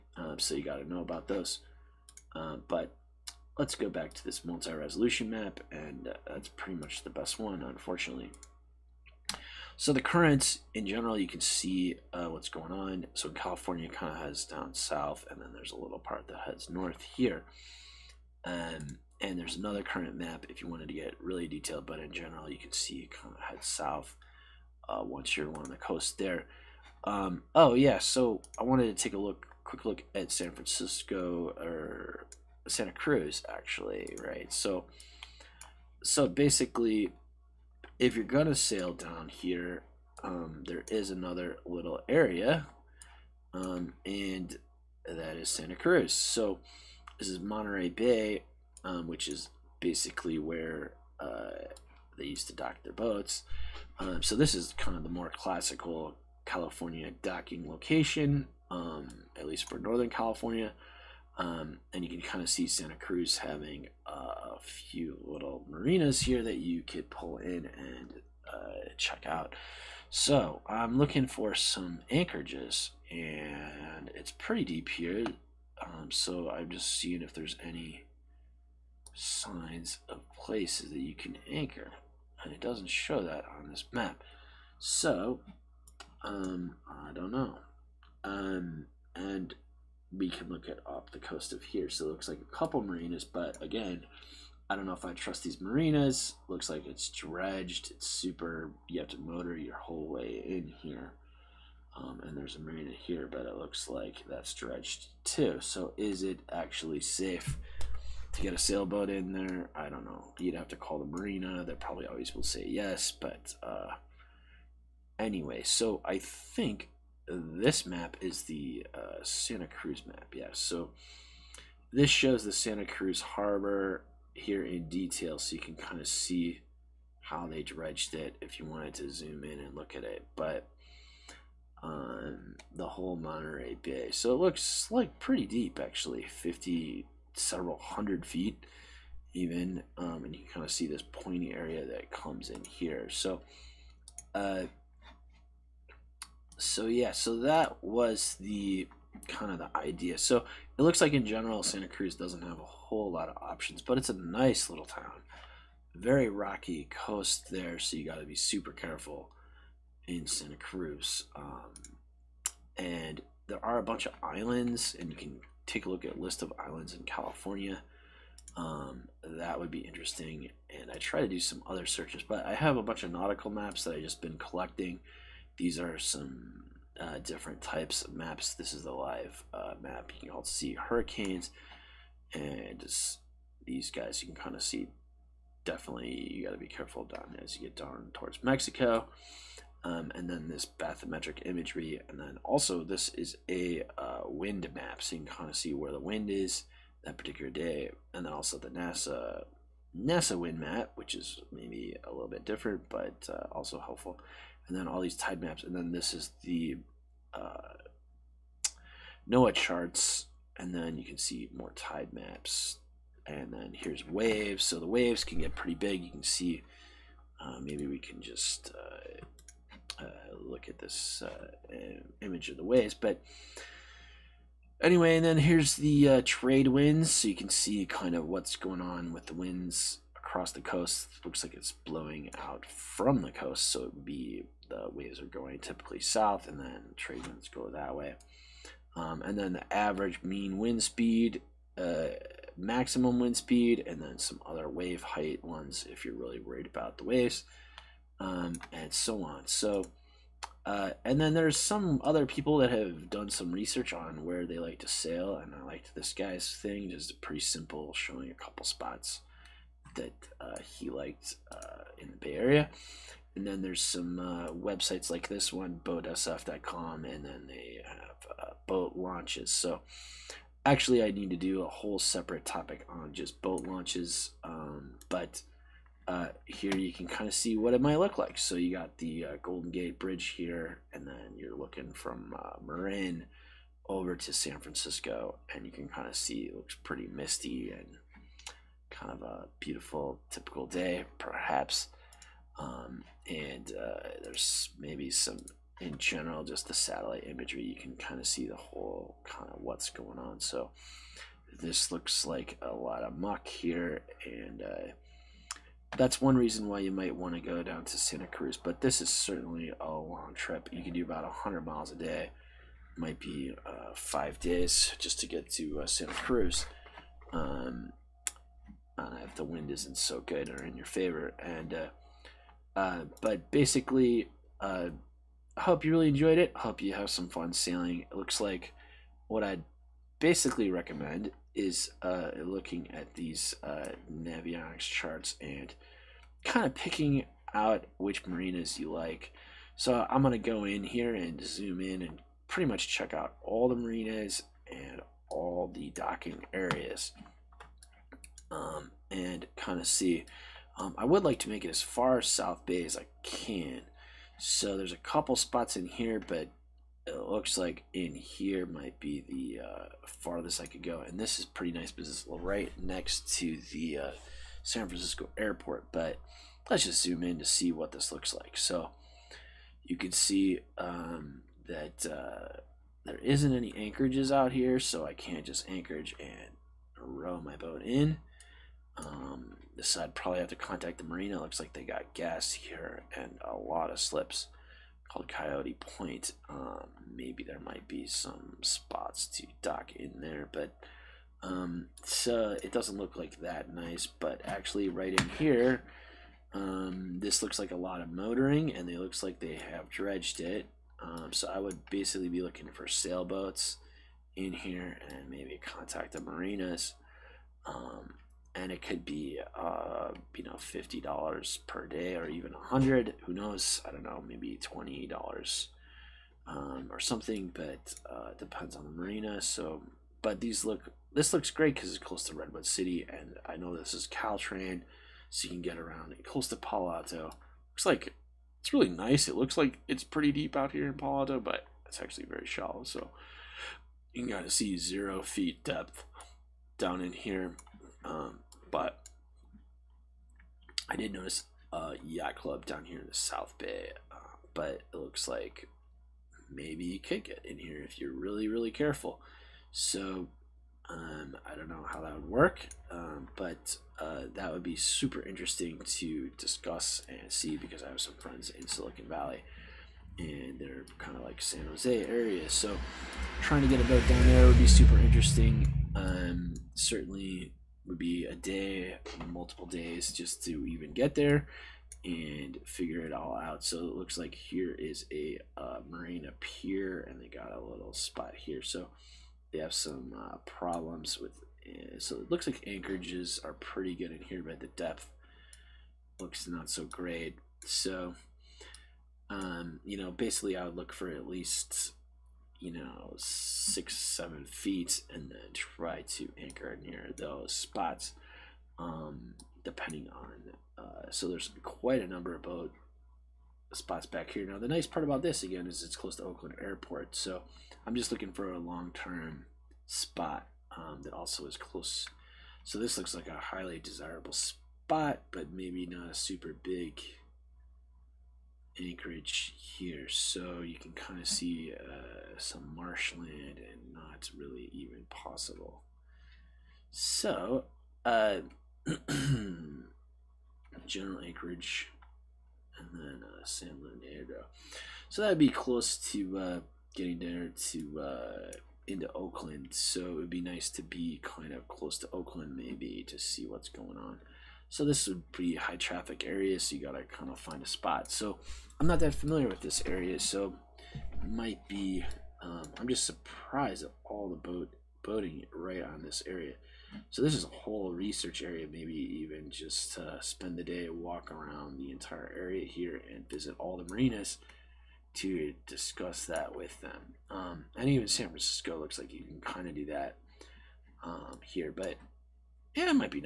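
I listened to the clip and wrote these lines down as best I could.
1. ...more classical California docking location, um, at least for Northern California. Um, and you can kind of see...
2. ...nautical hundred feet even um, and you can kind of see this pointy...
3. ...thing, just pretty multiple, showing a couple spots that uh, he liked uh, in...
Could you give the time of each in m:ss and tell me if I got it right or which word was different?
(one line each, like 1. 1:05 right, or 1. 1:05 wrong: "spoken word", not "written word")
1. 0:55 right
2. 2:17 wrong: "several", not "nautical"
3. 4:16 wrong: "simple", not "multiple".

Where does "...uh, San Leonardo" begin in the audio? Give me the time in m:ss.
8:53.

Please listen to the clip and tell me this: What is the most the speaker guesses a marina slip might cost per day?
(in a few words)
$100.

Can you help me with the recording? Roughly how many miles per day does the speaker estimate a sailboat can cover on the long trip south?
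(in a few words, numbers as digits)
100.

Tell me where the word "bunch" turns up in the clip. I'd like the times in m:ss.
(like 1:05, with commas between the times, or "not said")
2:43, 2:52.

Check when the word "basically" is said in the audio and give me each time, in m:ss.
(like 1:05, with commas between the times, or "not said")
0:36, 0:49, 5:23, 5:30, 6:41, 8:10.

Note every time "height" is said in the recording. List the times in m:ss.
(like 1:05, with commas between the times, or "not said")
4:05.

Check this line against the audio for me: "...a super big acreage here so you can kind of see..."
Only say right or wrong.
right.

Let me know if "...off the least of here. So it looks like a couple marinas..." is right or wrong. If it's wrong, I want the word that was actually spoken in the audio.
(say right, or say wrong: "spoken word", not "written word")
wrong: "coast", not "least".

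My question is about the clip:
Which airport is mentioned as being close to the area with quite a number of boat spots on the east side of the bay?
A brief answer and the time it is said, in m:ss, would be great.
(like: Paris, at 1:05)
Oakland Airport, at 8:26.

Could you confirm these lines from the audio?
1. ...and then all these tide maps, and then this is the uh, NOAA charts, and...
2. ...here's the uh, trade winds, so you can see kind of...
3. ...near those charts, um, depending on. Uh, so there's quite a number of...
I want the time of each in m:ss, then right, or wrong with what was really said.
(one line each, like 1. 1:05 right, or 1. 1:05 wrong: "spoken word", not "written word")
1. 3:24 right
2. 3:45 right
3. 8:16 wrong: "spots", not "charts".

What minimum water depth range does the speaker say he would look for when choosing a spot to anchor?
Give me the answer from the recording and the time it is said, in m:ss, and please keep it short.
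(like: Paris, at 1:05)
6 to 7 feet, at 8:13.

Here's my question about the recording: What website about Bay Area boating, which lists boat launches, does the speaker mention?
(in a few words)
boatsf.com.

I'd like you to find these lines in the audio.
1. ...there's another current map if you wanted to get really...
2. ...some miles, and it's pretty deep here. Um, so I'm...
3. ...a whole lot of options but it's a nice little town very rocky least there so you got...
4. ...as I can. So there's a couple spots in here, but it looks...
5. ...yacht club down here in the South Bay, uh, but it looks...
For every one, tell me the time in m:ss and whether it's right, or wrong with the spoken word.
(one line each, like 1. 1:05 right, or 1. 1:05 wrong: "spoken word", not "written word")
1. 0:19 right
2. 1:11 wrong: "anchorages", not "miles"
3. 2:32 wrong: "coast", not "least"
4. 5:52 right
5. 7:22 right.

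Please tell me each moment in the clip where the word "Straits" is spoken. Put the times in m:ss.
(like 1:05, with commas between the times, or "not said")
not said.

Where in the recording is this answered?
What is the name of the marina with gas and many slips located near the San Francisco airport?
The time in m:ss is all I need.
6:25.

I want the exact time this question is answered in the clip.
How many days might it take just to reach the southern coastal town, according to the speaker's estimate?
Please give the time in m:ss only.
5:13.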